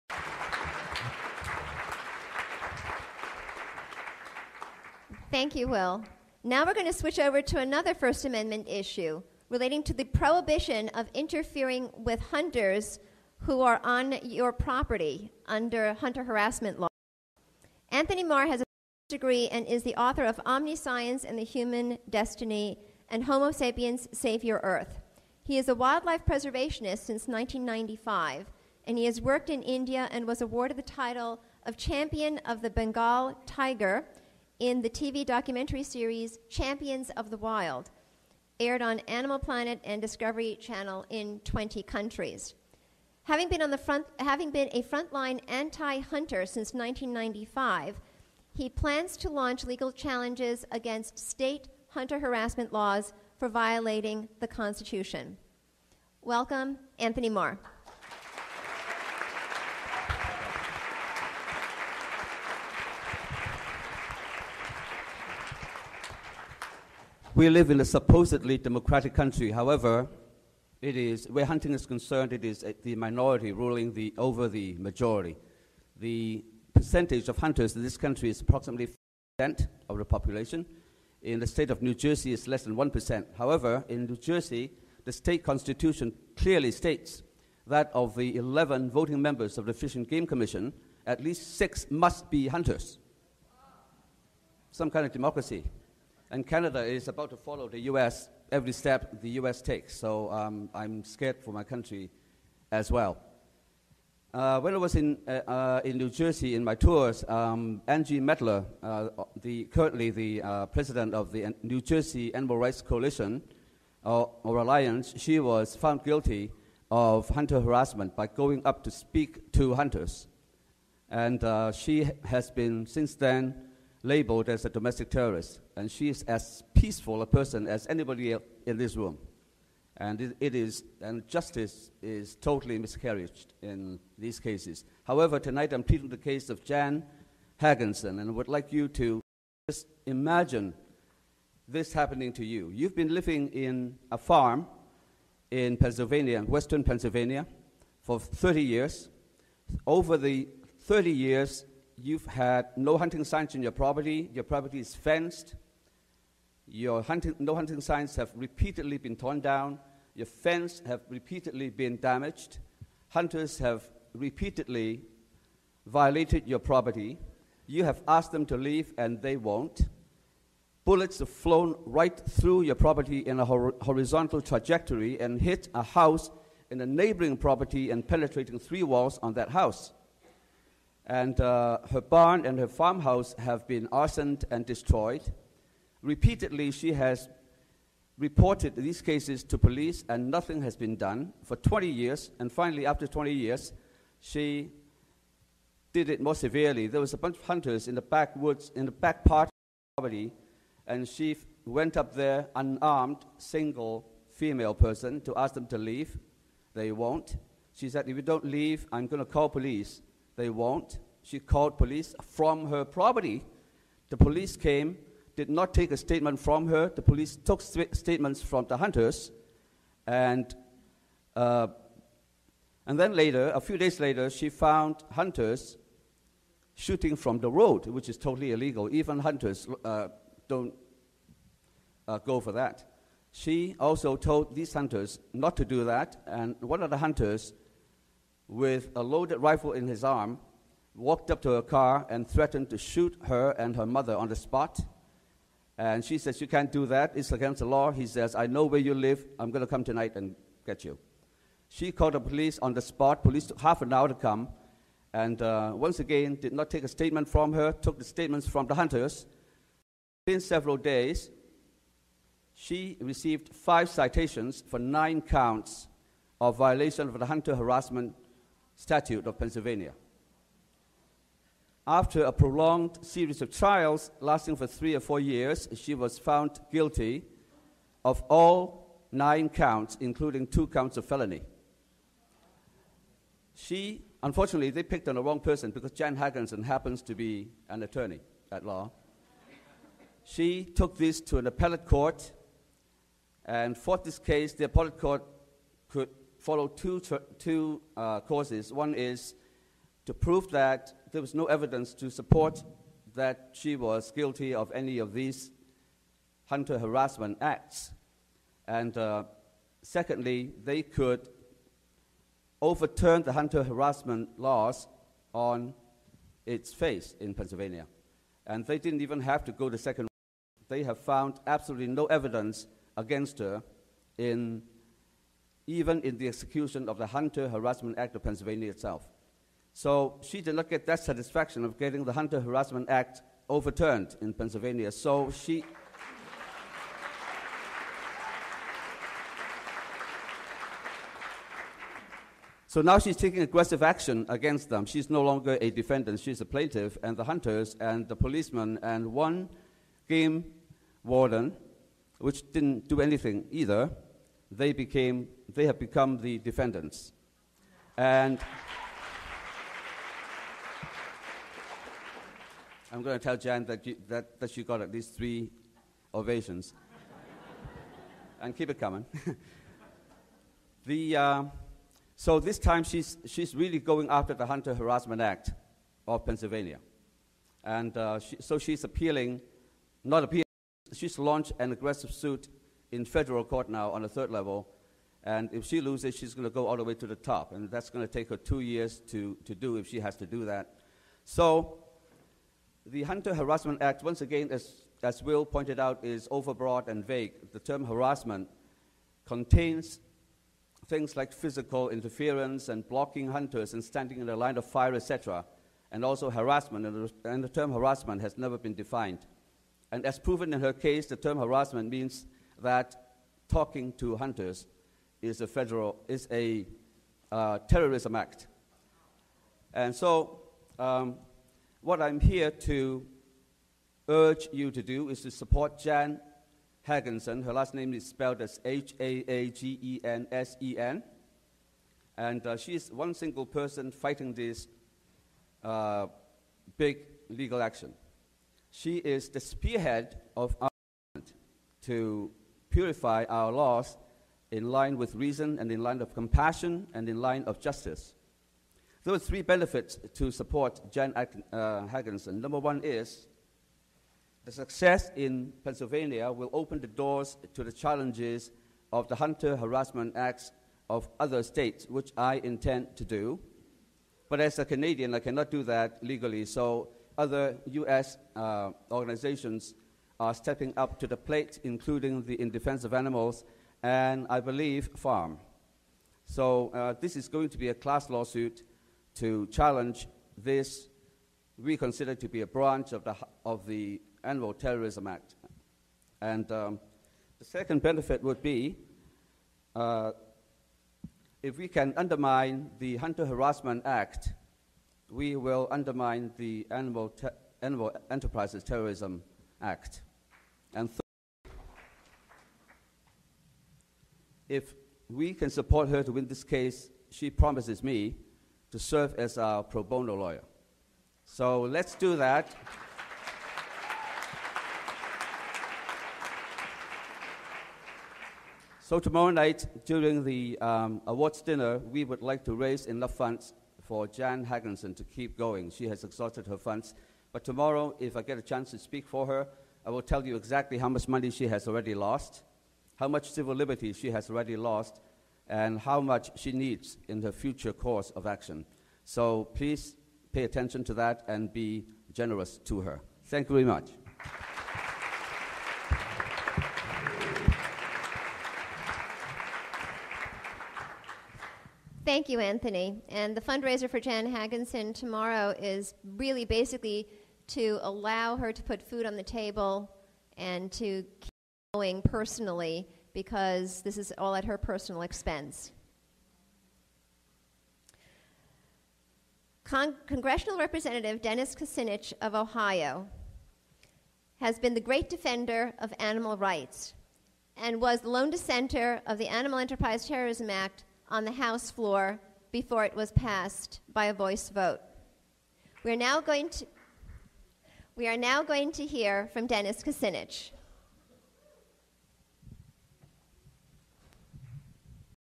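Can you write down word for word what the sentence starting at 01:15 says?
The percentage of hunters in this country is approximately 5% of the population.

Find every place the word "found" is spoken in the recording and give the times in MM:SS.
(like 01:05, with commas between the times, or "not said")
01:55, 03:44, 04:36, 05:20.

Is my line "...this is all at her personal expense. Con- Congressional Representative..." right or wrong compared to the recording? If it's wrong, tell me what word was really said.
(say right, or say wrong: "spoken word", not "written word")
right.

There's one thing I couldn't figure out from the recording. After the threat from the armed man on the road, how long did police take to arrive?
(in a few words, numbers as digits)
Half an hour.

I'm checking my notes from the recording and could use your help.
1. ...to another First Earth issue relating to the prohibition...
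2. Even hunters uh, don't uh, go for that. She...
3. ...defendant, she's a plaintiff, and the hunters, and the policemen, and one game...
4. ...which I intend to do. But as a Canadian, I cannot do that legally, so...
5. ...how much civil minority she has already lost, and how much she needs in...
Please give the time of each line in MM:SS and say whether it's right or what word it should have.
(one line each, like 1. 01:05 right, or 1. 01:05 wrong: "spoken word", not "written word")
1. 00:07 wrong: "Amendment", not "Earth"
2. 03:48 right
3. 05:45 right
4. 07:41 right
5. 08:52 wrong: "liberty", not "minority".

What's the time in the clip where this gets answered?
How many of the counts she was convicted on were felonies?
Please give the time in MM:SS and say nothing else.
04:40.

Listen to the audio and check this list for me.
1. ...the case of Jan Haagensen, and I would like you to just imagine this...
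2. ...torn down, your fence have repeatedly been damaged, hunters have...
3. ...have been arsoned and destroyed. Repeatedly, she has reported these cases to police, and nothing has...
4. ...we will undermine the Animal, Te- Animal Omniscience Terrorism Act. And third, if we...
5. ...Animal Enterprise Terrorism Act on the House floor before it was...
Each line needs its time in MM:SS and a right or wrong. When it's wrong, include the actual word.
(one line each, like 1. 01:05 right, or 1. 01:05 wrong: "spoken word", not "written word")
1. 02:16 right
2. 02:39 right
3. 03:03 right
4. 08:15 wrong: "Enterprises", not "Omniscience"
5. 09:39 right.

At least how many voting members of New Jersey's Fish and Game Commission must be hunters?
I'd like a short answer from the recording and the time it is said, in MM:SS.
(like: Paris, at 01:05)
6, at 01:31.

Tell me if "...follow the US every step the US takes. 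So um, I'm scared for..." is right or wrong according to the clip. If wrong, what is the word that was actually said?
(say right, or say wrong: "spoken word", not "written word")
right.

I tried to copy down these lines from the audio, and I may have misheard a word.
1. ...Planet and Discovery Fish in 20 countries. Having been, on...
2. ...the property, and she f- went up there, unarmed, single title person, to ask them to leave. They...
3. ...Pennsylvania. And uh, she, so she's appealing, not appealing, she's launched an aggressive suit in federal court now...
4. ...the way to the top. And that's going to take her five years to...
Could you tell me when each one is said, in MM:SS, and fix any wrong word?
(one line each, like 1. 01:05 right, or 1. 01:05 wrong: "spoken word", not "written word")
1. 00:39 wrong: "Channel", not "Fish"
2. 03:19 wrong: "female", not "title"
3. 06:16 right
4. 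06:26 wrong: "two", not "five".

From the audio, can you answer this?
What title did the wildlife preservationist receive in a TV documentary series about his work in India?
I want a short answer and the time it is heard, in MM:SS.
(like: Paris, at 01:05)
Champion of the Bengal Tiger, at 00:31.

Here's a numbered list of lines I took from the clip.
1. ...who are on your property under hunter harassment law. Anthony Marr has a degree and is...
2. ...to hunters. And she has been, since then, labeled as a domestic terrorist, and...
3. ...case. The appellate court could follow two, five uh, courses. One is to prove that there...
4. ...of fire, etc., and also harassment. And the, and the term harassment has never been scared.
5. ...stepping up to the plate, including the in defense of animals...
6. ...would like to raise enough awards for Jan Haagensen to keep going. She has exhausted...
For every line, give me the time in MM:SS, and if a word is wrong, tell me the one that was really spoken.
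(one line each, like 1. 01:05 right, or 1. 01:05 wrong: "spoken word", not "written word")
1. 00:13 right
2. 01:59 right
3. 04:54 wrong: "two", not "five"
4. 06:44 wrong: "defined", not "scared"
5. 07:50 right
6. 08:42 wrong: "funds", not "awards".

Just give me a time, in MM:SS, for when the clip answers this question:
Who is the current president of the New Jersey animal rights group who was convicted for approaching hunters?
01:47.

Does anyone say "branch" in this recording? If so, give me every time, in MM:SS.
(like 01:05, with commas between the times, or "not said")
08:02.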